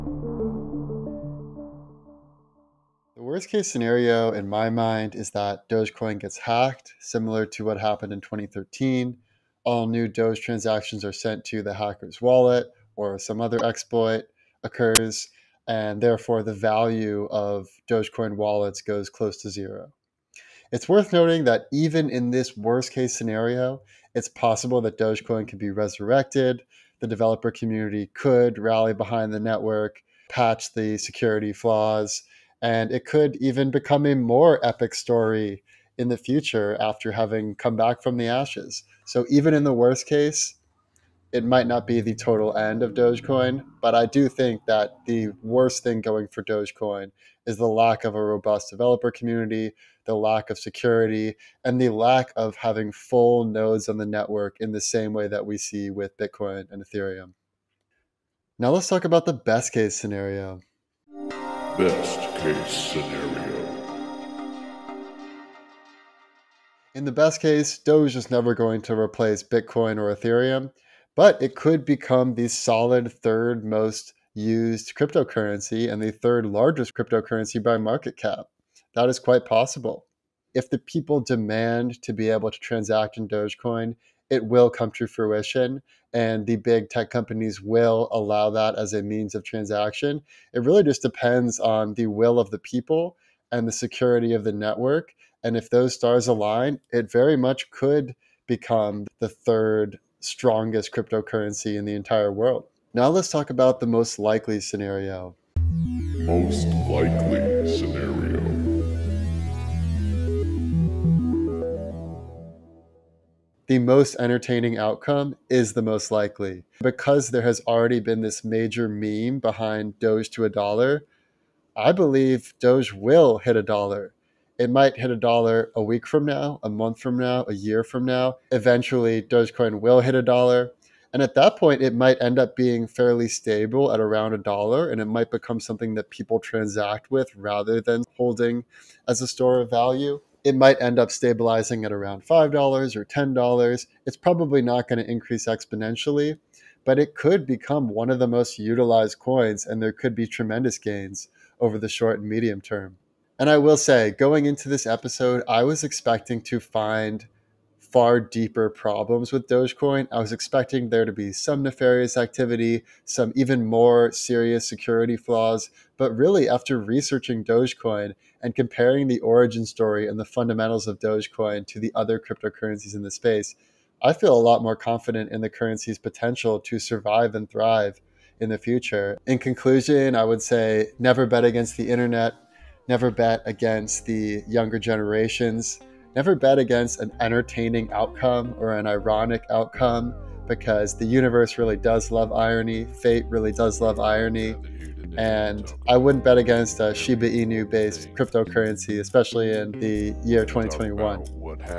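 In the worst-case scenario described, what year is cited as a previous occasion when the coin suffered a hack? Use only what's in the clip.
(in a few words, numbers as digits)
2013.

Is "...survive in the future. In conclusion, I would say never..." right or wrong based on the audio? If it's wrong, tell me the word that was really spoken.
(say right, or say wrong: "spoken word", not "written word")
wrong: "thrive", not "survive".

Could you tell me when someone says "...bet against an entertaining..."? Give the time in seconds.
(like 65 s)
186 s.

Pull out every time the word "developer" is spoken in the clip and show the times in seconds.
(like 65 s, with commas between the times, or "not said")
27 s, 48 s.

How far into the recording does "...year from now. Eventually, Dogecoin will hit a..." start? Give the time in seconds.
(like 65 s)
127 s.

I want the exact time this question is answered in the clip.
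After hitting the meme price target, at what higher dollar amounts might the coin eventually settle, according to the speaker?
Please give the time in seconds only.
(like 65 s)
142 s.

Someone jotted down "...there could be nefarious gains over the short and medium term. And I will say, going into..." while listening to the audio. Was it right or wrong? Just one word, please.
wrong.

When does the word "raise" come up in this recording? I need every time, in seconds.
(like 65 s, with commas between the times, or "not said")
not said.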